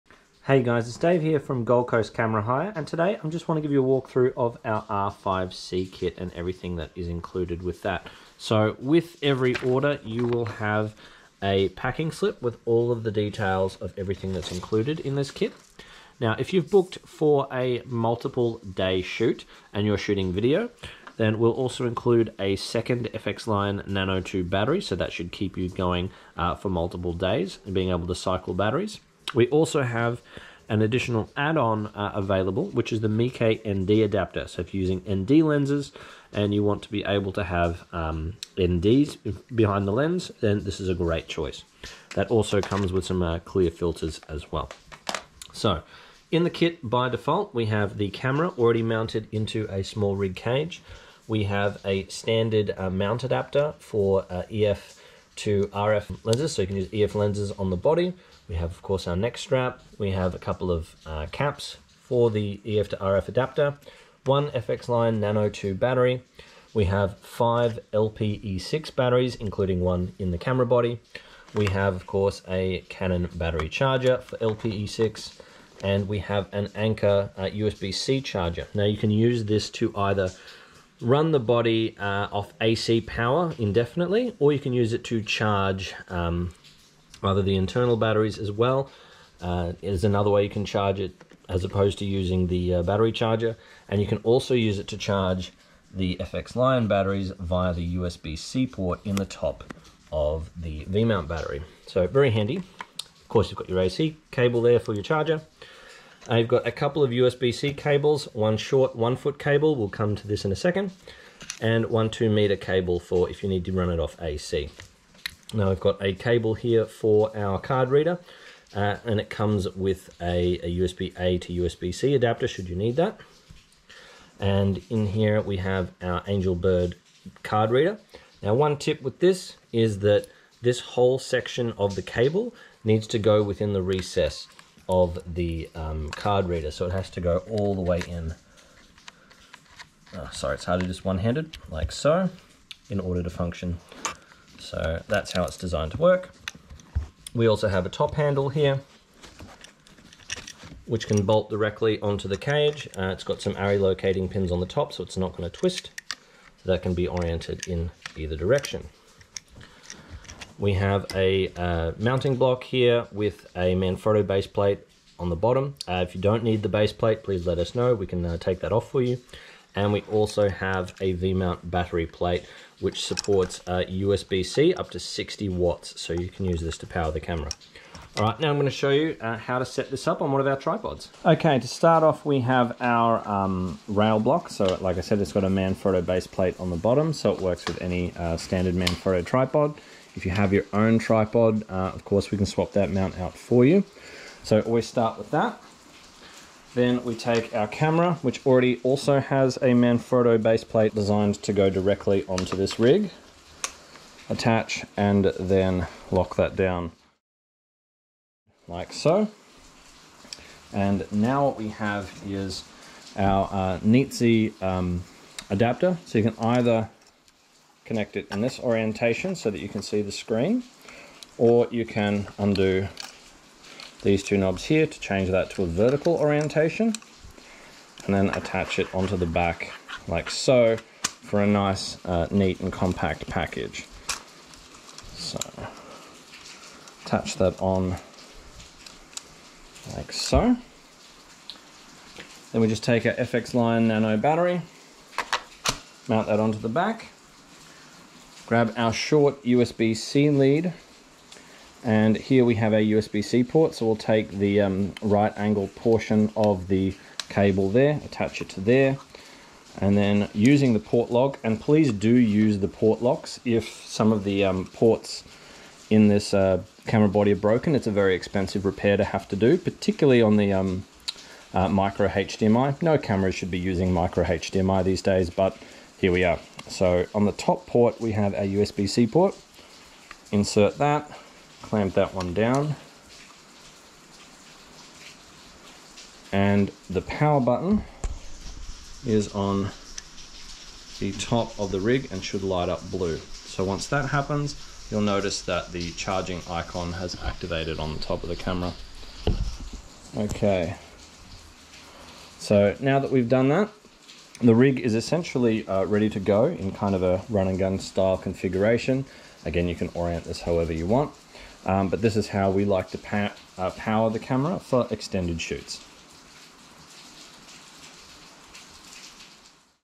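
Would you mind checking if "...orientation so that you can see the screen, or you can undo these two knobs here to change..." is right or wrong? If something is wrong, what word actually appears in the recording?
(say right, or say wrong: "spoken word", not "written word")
right.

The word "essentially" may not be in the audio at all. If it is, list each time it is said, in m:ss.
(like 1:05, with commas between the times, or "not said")
5:04.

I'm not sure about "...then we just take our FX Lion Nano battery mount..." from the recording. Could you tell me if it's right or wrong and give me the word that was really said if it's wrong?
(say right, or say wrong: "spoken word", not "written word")
right.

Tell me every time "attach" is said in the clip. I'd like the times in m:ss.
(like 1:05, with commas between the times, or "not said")
3:24, 3:48, 3:57, 4:18.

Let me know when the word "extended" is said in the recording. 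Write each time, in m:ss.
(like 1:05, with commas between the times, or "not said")
5:14.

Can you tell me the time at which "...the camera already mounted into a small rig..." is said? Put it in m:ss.
0:47.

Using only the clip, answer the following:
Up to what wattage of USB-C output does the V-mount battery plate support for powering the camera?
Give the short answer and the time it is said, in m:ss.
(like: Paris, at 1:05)
60 watts, at 2:54.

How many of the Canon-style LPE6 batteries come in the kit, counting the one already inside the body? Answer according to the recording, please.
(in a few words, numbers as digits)
5.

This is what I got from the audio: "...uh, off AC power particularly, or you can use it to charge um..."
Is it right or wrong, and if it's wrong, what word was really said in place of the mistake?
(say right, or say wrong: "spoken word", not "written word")
wrong: "indefinitely", not "particularly".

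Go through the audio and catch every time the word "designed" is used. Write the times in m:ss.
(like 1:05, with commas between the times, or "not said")
2:25, 3:20.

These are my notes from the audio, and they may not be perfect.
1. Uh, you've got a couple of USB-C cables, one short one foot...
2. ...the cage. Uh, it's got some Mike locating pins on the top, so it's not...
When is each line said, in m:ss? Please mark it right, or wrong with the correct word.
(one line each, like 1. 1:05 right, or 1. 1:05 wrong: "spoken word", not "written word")
1. 1:46 right
2. 2:32 wrong: "ARRI", not "Mike".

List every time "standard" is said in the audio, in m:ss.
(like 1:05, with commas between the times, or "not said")
0:52, 3:08.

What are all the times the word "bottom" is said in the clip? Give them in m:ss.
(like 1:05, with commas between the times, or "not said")
2:45, 3:06.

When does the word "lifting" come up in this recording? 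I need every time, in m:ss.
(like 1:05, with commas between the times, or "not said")
not said.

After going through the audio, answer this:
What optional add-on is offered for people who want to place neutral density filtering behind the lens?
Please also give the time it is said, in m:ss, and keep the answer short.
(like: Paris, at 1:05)
Mike ND adapter, at 0:33.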